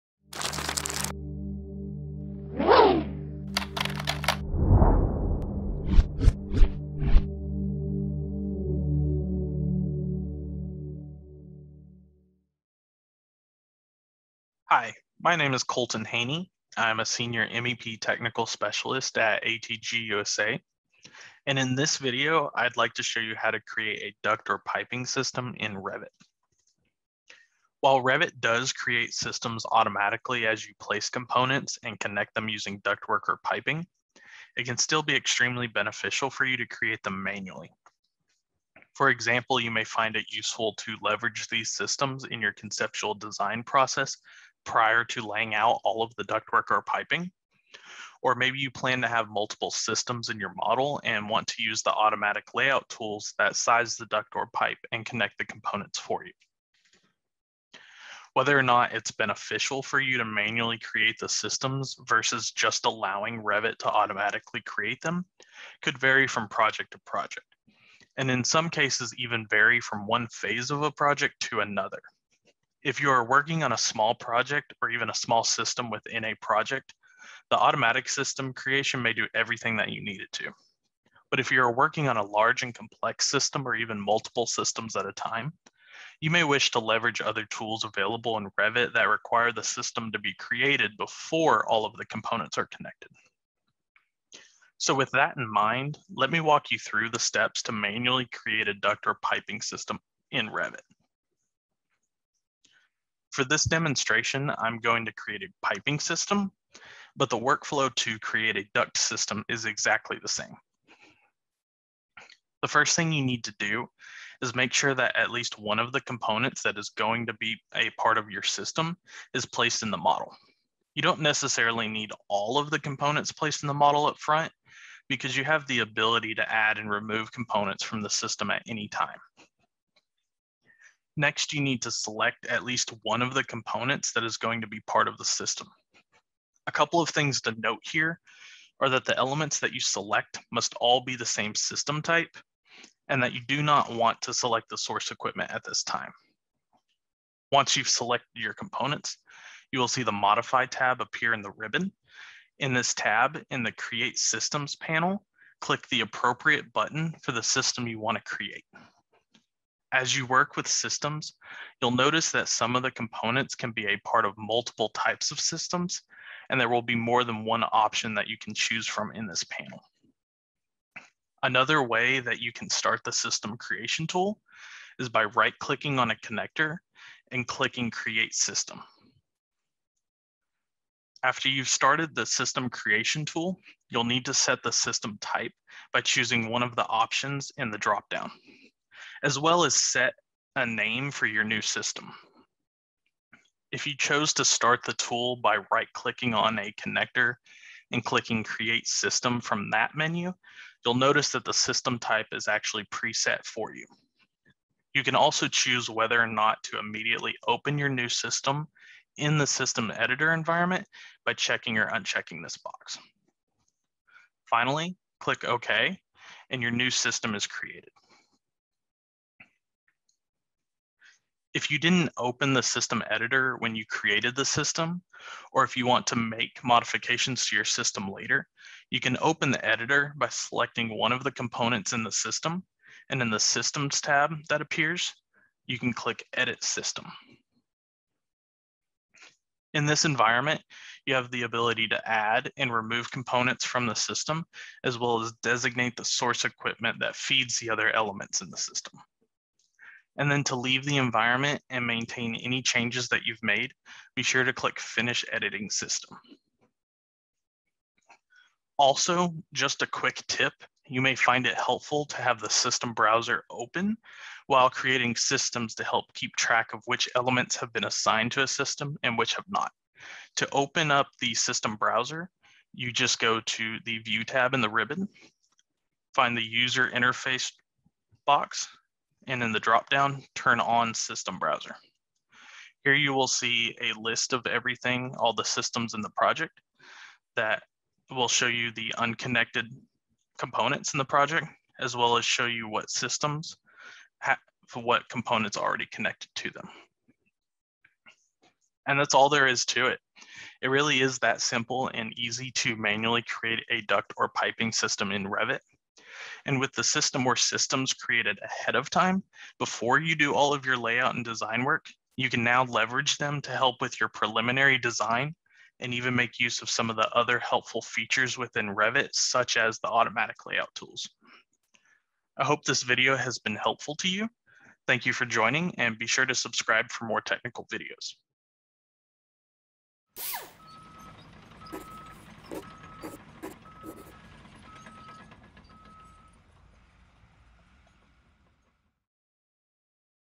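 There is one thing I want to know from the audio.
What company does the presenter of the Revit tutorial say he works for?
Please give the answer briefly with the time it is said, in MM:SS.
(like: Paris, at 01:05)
ATG USA, at 00:19.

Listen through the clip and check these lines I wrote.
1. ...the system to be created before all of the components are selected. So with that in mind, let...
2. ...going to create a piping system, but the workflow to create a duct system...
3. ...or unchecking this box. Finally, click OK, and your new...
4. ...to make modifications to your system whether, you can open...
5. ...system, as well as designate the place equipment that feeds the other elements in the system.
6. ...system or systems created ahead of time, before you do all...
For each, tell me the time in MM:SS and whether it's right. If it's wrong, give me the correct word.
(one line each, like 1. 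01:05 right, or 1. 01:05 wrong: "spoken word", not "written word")
1. 01:29 wrong: "connected", not "selected"
2. 01:44 right
3. 03:31 right
4. 03:46 wrong: "later", not "whether"
5. 04:03 wrong: "source", not "place"
6. 05:06 right.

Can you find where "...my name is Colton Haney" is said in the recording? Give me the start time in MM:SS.
00:15.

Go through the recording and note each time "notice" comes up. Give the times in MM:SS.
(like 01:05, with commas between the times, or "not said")
02:41, 03:20.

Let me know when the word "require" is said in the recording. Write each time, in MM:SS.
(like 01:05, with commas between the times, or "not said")
01:29.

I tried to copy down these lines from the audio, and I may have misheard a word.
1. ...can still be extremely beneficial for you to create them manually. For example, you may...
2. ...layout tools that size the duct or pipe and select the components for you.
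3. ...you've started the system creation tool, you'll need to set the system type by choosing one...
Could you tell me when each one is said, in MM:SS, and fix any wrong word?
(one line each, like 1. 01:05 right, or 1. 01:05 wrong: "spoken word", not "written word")
1. 00:34 right
2. 00:52 wrong: "connect", not "select"
3. 03:01 right.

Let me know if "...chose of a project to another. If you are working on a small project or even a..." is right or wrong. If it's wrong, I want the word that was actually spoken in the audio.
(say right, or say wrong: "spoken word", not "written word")
wrong: "phase", not "chose".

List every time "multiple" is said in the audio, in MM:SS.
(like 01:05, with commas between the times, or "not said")
00:49, 01:23, 02:44.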